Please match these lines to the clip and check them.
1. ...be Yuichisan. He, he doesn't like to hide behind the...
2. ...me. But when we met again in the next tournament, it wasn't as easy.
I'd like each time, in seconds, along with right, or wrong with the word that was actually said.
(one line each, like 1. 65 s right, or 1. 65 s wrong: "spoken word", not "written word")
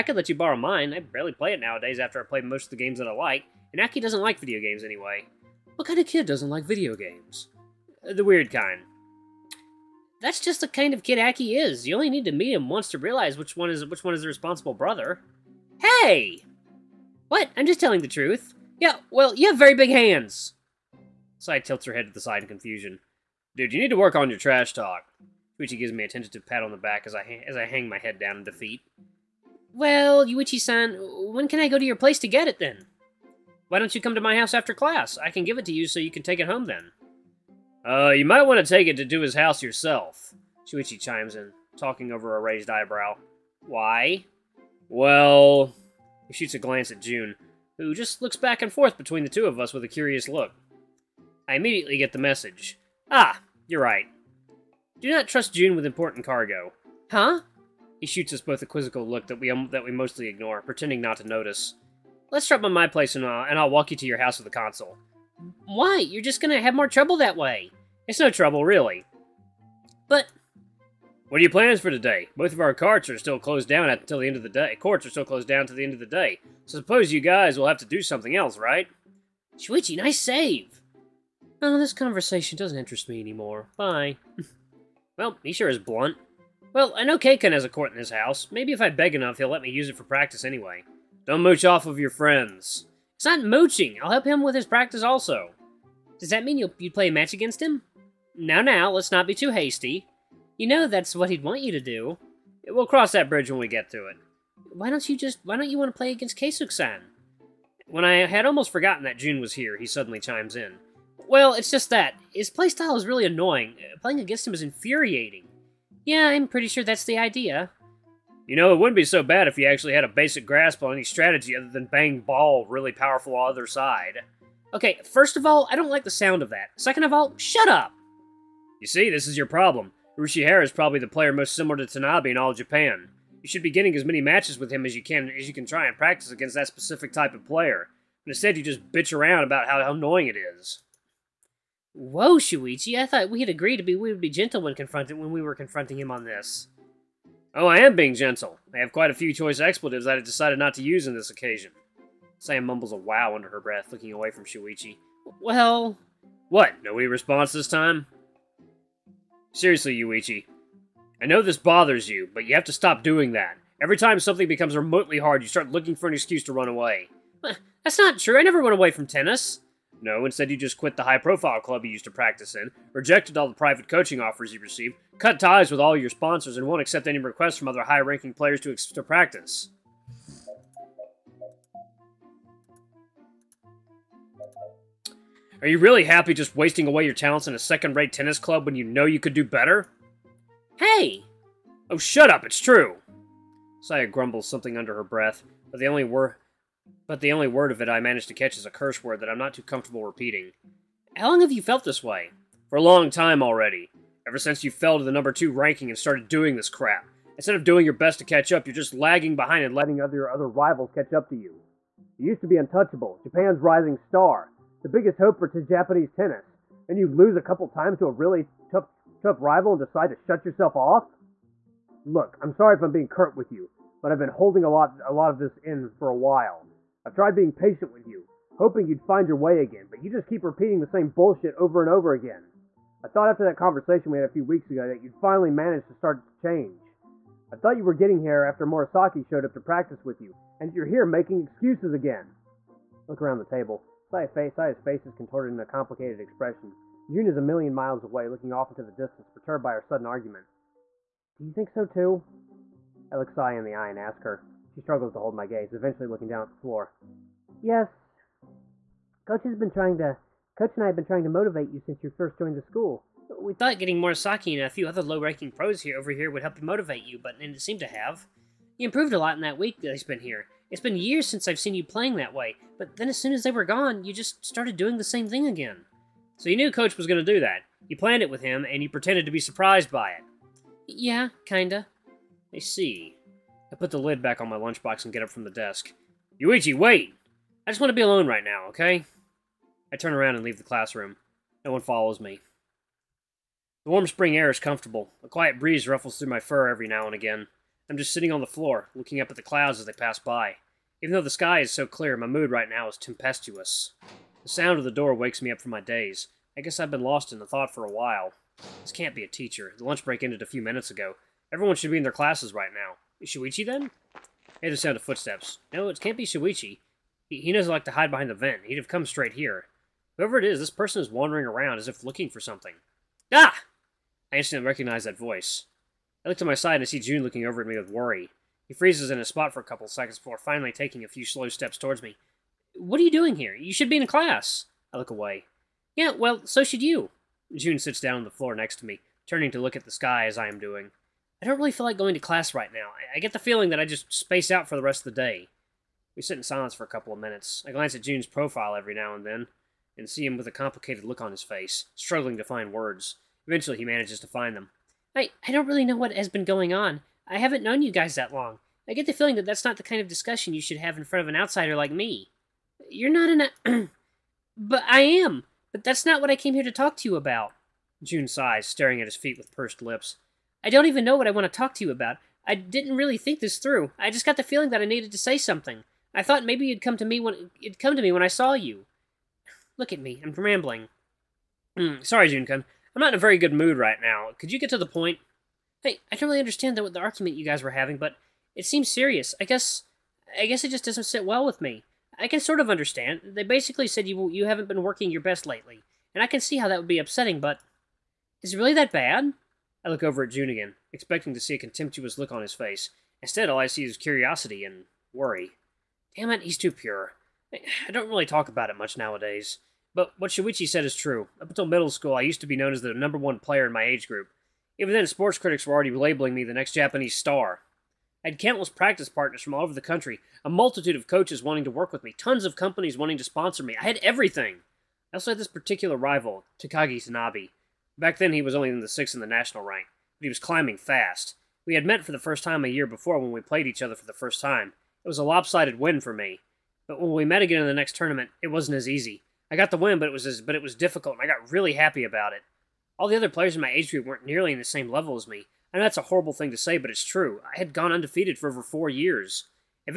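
1. 316 s wrong: "Shuichi", not "Yuichisan"
2. 436 s right.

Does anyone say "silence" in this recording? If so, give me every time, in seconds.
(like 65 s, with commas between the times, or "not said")
346 s.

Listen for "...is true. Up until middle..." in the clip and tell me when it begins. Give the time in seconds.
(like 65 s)
410 s.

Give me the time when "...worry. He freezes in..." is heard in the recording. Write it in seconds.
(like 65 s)
327 s.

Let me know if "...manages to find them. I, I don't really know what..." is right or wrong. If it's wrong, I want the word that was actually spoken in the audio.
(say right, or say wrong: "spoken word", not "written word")
right.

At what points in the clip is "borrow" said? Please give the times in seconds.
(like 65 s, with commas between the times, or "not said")
0 s.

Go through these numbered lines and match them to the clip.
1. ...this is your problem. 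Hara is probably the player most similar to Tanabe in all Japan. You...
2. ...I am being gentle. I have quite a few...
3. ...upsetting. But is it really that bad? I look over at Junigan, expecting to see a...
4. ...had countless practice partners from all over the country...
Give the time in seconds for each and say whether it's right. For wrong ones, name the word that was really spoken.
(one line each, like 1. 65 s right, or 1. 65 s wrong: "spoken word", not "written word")
1. 129 s right
2. 147 s right
3. 396 s right
4. 418 s right.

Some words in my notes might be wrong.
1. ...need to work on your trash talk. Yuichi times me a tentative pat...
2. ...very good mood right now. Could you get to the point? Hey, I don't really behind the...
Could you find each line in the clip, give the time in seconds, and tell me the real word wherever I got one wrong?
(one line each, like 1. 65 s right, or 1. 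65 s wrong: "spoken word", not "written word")
1. 23 s wrong: "gives", not "times"
2. 383 s wrong: "understand", not "behind".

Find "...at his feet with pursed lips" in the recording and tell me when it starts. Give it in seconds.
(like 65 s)
368 s.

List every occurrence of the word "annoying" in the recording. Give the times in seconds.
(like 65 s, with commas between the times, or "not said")
113 s, 139 s.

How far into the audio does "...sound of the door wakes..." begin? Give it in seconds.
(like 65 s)
304 s.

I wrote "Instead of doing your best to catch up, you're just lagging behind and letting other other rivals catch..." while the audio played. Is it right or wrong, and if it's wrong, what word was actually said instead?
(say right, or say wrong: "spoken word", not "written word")
right.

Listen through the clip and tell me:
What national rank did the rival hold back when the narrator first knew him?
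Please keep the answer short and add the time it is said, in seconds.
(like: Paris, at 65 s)
6th, at 428 s.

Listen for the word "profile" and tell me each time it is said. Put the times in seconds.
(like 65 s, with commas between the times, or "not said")
171 s, 348 s.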